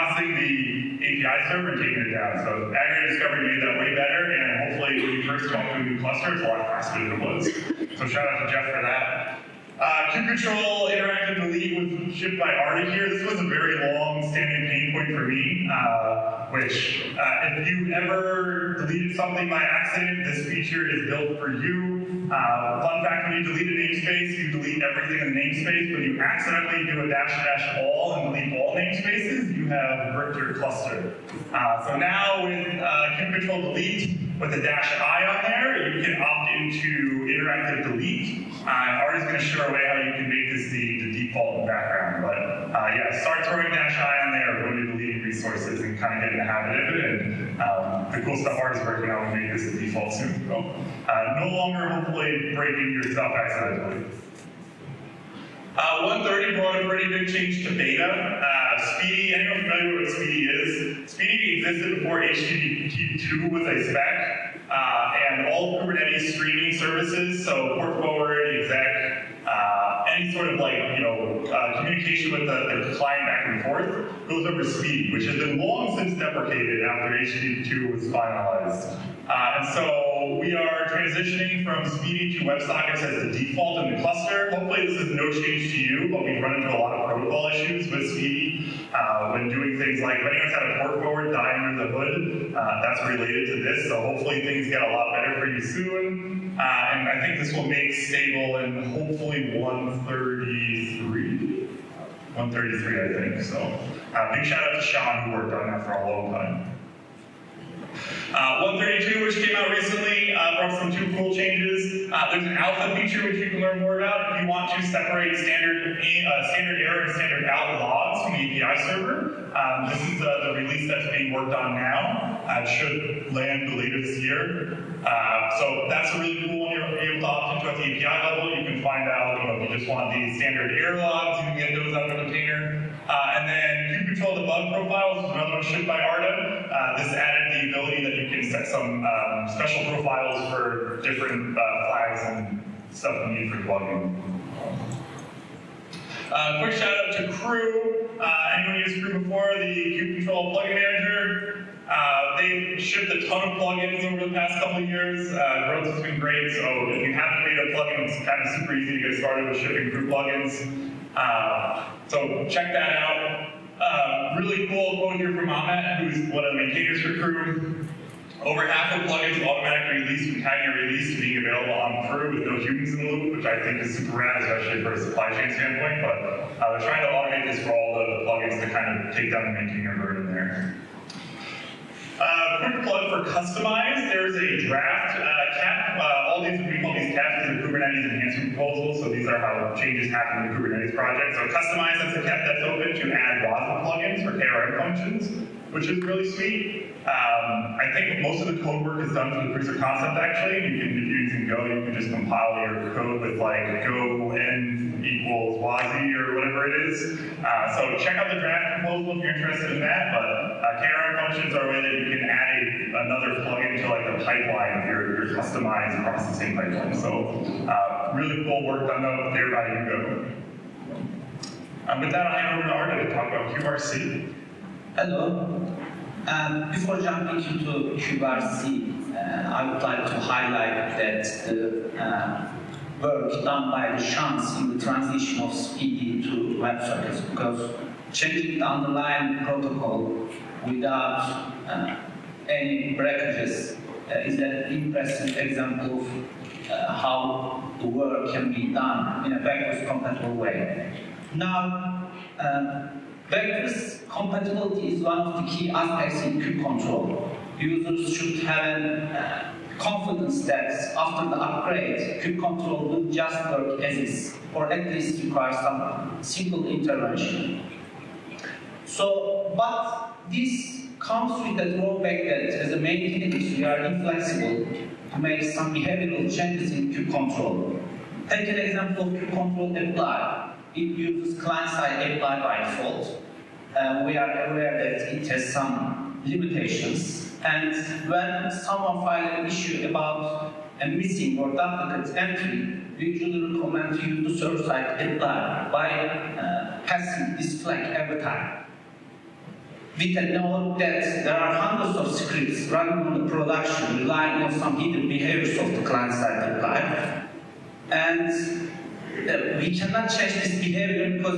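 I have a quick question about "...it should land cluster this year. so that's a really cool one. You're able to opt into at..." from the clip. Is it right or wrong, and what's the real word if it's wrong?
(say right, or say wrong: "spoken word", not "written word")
wrong: "later", not "cluster".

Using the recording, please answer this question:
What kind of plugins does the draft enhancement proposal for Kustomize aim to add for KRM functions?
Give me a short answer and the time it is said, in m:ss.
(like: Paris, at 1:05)
WASM plugins, at 3:13.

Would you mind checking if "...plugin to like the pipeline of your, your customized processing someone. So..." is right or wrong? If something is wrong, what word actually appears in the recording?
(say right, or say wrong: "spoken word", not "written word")
wrong: "pipeline", not "someone".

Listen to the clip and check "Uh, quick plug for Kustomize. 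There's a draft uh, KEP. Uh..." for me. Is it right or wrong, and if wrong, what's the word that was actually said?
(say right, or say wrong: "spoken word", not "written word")
right.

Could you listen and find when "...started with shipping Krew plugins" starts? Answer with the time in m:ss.
2:39.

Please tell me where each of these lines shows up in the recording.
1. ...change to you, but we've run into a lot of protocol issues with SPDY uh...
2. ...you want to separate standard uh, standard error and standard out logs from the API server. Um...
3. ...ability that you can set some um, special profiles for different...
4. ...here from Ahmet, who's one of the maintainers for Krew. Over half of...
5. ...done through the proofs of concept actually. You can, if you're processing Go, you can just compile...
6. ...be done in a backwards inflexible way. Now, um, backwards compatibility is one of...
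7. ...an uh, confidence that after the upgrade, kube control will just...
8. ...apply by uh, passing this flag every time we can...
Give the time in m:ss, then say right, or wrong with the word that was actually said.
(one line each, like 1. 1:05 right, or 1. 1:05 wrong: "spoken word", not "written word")
1. 1:25 right
2. 1:54 right
3. 2:17 right
4. 2:45 right
5. 3:19 wrong: "using", not "processing"
6. 4:08 wrong: "compatible", not "inflexible"
7. 4:18 right
8. 4:55 right.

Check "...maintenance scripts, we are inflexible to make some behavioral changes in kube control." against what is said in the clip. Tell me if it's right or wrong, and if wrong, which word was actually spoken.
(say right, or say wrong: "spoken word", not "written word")
wrong: "activists", not "scripts".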